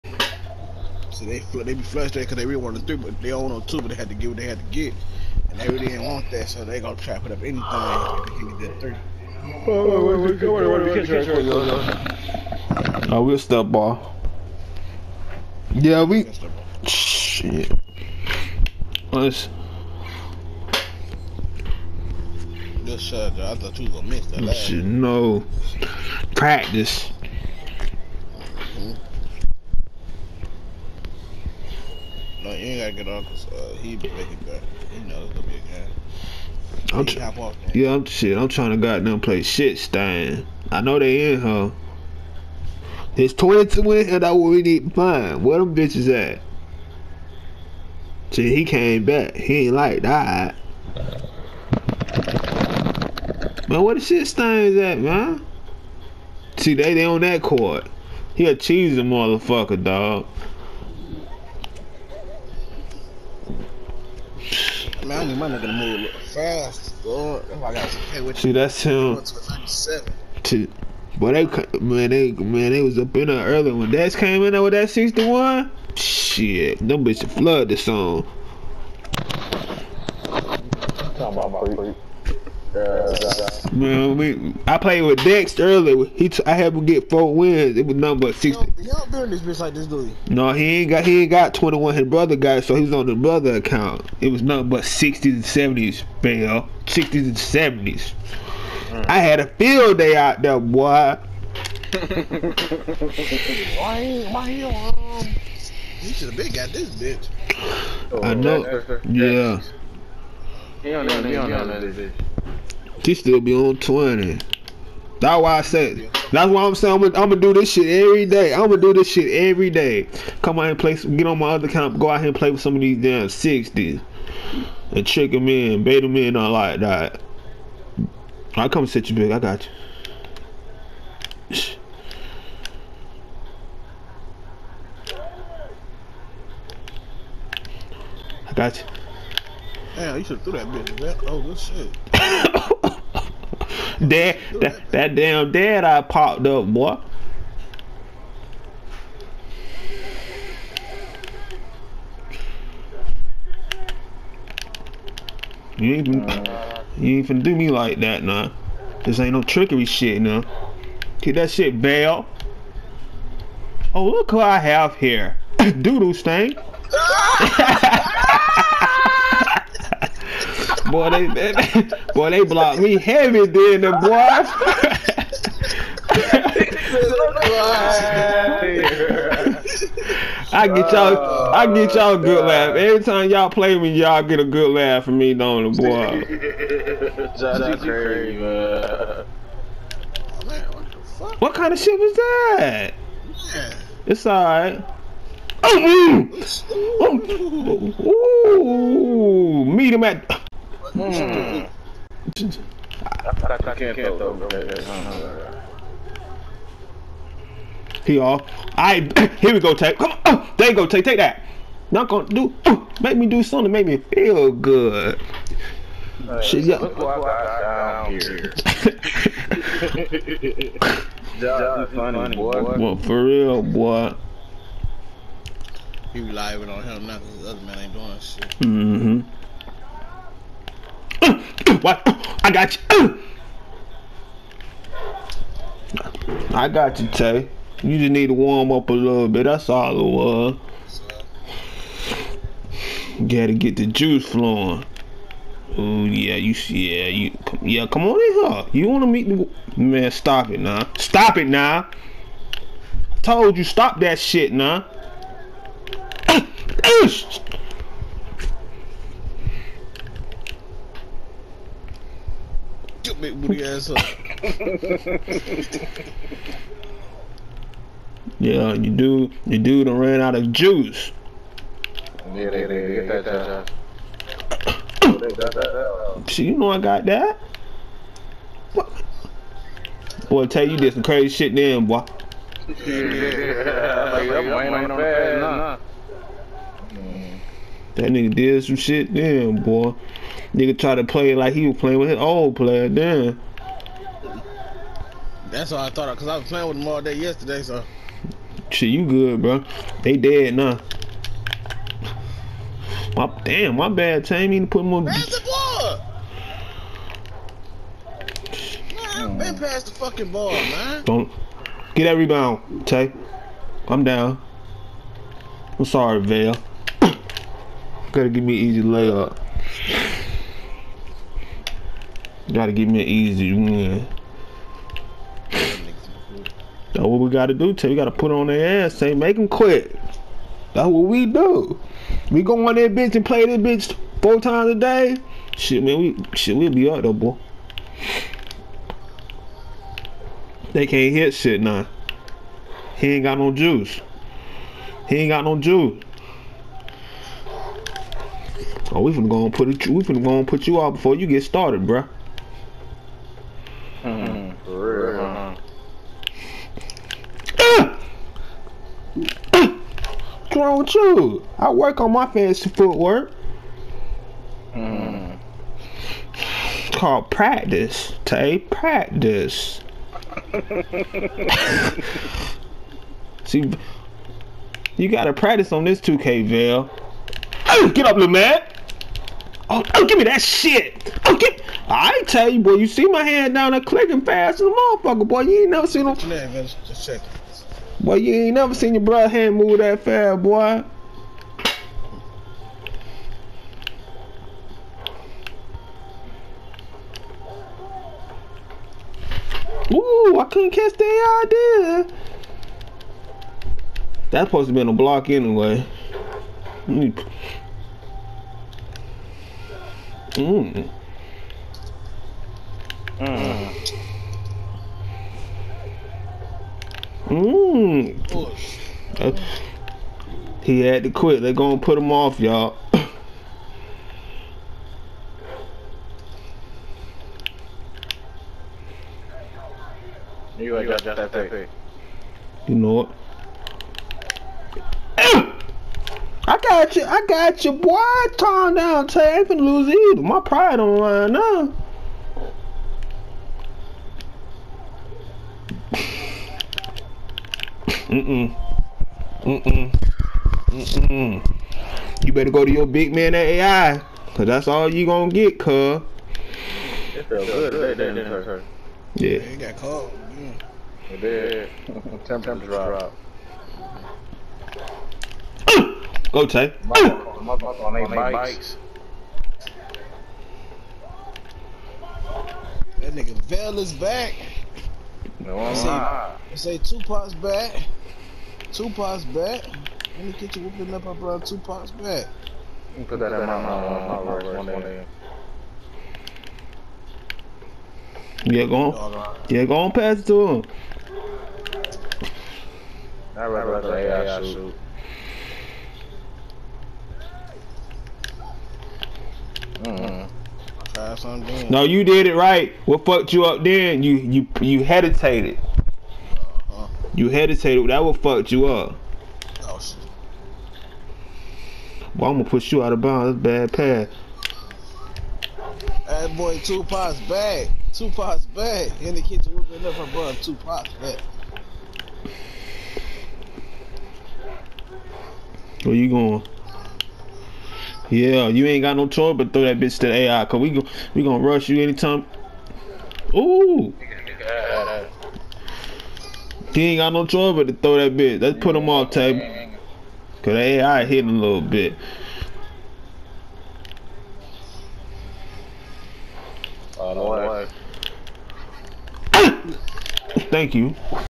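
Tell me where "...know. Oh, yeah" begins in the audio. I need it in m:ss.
1:48.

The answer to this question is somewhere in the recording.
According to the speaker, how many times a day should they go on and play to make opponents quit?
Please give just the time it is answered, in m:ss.
5:34.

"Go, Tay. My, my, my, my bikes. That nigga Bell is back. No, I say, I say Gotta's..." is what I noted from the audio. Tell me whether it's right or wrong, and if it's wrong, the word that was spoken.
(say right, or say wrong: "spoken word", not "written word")
wrong: "Tupac", not "Gotta".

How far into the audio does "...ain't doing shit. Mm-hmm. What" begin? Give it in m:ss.
3:47.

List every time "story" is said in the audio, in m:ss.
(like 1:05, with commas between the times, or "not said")
not said.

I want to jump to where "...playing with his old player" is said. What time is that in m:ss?
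4:51.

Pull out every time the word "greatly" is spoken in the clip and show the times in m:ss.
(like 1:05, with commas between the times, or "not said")
not said.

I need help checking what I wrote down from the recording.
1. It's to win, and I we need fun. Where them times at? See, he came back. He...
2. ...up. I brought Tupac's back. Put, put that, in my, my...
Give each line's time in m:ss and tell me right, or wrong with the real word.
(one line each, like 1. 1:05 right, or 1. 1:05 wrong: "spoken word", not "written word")
1. 0:43 wrong: "bitches", not "times"
2. 8:00 right.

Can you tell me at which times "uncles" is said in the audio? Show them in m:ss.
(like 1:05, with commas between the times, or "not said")
0:33.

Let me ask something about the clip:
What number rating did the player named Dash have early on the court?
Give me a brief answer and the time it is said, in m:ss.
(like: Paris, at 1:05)
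61, at 1:14.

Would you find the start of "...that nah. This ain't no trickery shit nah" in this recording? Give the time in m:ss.
2:38.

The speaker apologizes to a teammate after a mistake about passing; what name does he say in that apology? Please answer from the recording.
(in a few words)
Tammy.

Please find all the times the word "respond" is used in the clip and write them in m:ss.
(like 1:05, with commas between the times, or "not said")
not said.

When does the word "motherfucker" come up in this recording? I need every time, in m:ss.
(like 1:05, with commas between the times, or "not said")
0:59, 6:24.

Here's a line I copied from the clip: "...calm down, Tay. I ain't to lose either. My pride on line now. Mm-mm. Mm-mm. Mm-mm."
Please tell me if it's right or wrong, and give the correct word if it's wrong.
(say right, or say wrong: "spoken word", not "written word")
right.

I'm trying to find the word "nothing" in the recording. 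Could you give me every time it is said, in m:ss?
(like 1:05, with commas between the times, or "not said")
1:27, 1:34.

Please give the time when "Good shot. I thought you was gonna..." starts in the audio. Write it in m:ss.
0:22.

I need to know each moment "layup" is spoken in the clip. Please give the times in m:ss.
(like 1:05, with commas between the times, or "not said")
5:18.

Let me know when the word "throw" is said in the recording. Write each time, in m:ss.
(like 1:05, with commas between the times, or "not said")
8:49, 8:57.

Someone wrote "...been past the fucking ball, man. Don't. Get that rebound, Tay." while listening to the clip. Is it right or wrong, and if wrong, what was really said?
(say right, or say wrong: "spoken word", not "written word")
right.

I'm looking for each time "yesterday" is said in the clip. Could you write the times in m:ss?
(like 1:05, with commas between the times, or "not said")
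4:57.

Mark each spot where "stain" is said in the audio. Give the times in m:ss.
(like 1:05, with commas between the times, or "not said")
0:39, 0:54, 2:46.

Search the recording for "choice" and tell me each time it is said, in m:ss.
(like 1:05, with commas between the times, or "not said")
8:49, 8:57.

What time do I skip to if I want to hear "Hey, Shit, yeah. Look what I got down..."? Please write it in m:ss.
3:36.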